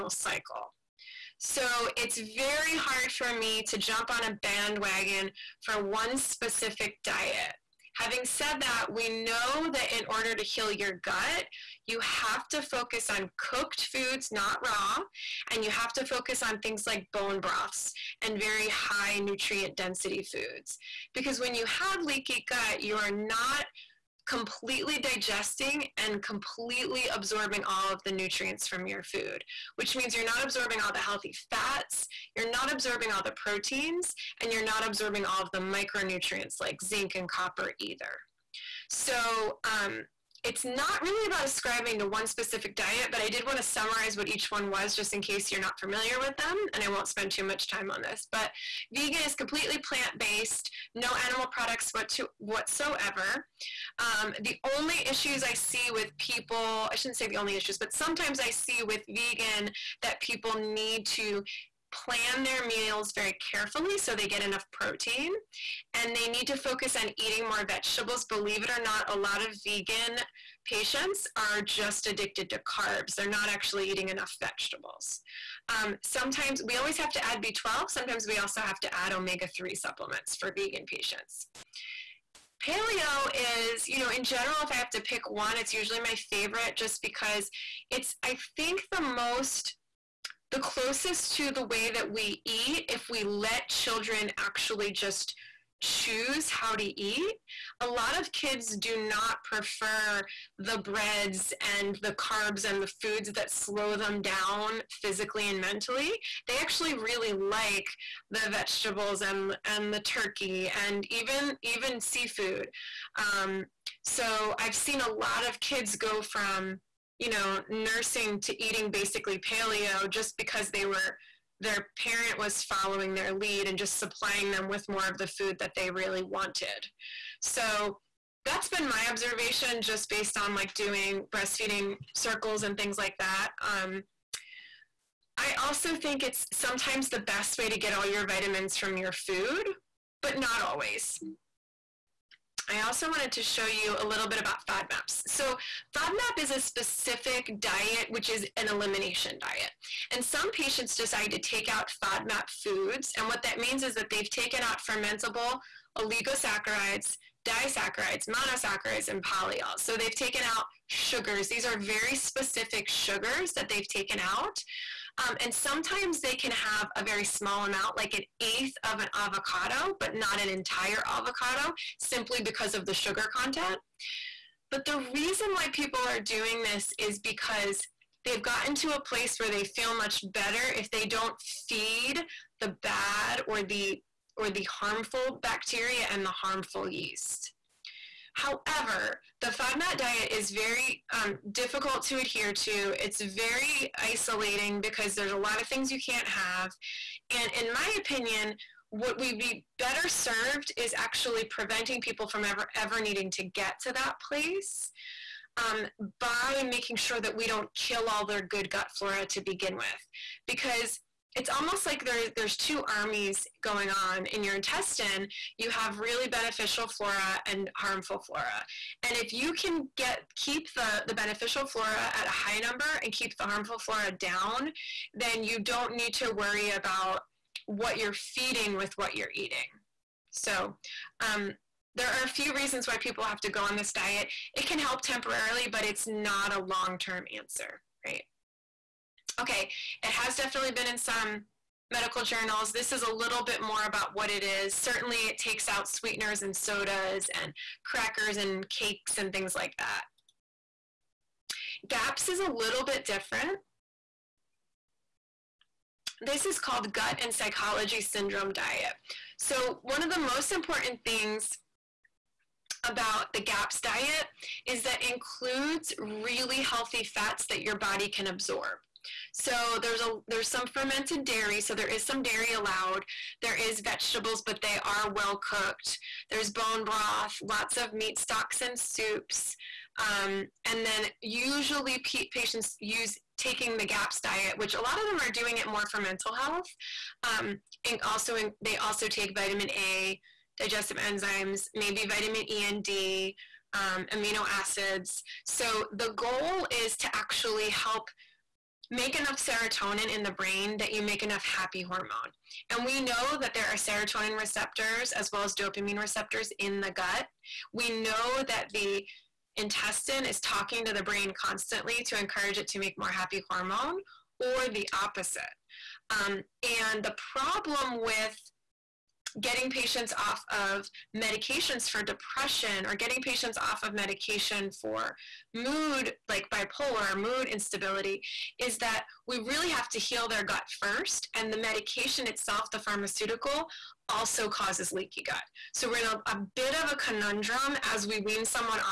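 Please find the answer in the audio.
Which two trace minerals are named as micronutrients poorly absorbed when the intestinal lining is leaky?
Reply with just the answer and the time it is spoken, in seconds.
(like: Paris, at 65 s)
zinc and copper, at 36 s.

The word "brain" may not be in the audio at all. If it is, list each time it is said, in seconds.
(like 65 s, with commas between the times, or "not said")
300 s, 311 s.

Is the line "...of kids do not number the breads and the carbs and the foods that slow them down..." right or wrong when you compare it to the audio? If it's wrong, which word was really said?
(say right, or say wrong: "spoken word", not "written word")
wrong: "prefer", not "number".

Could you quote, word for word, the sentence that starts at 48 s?
But vegan is completely plant based, no animal products whatsoever.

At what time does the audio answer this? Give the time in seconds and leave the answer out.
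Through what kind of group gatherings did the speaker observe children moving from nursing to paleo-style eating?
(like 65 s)
131 s.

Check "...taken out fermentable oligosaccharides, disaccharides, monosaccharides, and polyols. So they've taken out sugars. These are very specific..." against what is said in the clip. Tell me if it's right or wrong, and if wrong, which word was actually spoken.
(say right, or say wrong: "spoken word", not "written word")
right.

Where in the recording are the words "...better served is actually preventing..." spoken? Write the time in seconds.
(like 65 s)
199 s.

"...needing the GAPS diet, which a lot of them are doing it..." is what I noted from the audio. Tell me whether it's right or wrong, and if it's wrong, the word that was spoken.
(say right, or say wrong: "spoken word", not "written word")
wrong: "taking", not "needing".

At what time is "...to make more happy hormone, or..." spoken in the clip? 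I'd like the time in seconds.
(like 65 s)
312 s.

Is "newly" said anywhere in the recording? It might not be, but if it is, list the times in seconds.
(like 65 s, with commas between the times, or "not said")
not said.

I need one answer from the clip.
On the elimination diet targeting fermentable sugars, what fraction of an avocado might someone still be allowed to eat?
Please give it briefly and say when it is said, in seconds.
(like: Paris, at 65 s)
an eighth, at 168 s.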